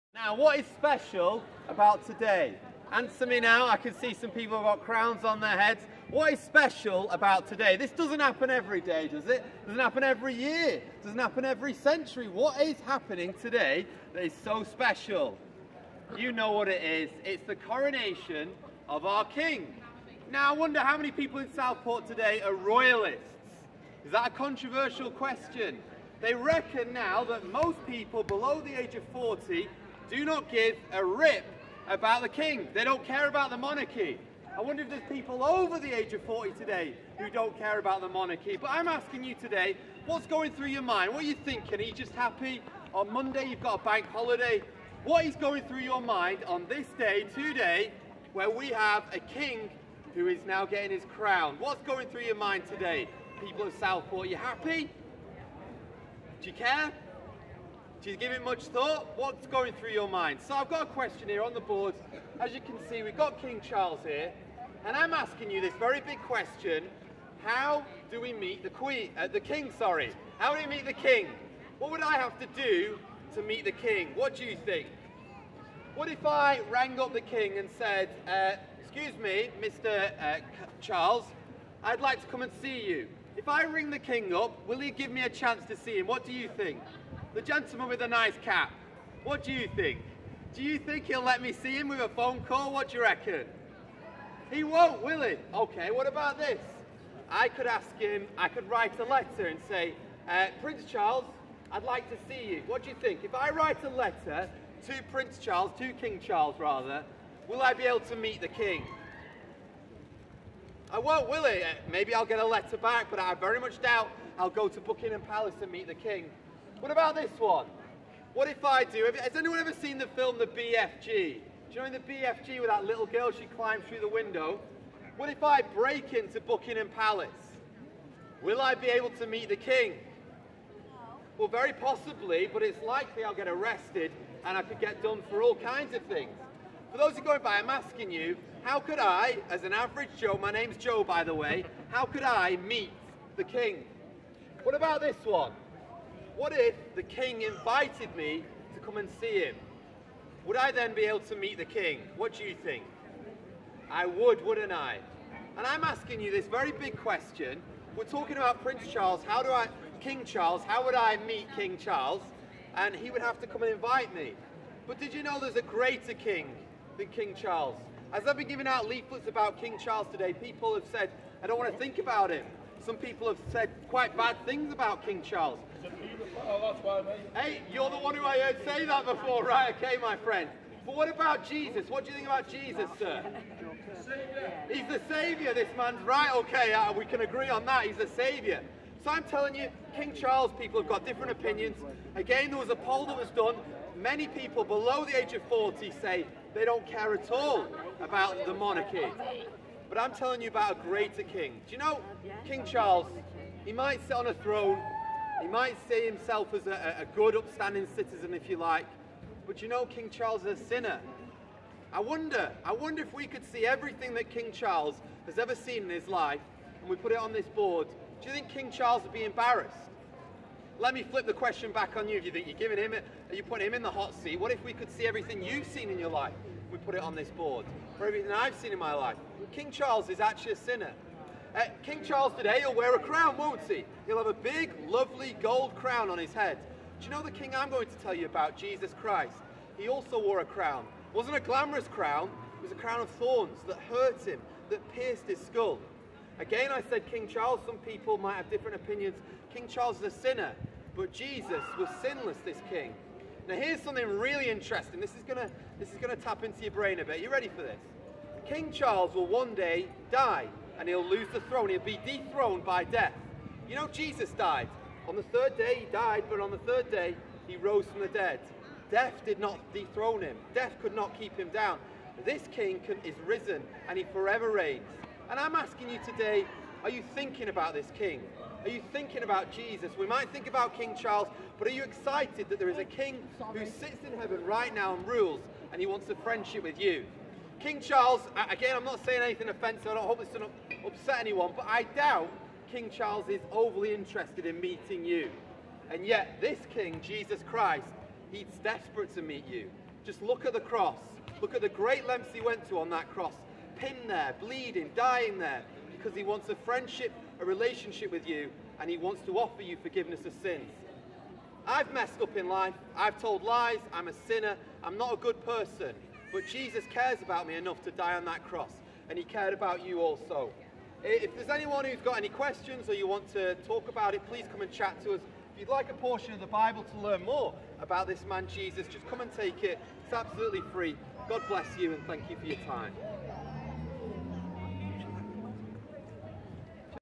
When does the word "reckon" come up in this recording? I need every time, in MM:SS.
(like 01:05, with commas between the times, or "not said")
00:26, 01:33.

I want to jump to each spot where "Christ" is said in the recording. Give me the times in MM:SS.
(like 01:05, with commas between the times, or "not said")
03:59, 04:57.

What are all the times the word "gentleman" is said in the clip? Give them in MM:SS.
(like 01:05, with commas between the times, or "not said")
01:27.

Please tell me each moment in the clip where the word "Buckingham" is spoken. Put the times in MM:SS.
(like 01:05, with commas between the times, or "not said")
01:54, 02:06.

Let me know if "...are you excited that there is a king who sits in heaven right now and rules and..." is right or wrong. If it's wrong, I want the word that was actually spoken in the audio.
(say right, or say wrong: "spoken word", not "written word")
right.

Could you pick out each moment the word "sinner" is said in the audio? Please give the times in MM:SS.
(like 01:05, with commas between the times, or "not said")
03:30, 03:50, 04:10, 05:14.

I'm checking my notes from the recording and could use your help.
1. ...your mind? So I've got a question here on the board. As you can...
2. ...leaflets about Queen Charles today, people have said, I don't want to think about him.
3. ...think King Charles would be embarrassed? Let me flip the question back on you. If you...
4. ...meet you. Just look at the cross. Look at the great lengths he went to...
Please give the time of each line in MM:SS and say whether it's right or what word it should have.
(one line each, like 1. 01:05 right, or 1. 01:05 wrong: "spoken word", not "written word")
1. 00:59 right
2. 02:48 wrong: "King", not "Queen"
3. 03:38 right
4. 04:59 right.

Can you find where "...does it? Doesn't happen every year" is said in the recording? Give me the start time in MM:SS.
00:09.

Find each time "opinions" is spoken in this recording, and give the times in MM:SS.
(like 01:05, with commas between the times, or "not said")
03:11, 04:08.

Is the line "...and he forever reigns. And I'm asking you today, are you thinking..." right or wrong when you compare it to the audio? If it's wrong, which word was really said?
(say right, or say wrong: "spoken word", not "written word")
right.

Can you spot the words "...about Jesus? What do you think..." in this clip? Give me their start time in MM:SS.
03:01.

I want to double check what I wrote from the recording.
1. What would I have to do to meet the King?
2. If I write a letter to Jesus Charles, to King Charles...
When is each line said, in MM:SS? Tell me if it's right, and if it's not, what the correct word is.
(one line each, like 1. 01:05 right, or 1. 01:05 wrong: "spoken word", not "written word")
1. 01:11 right
2. 01:43 wrong: "Prince", not "Jesus".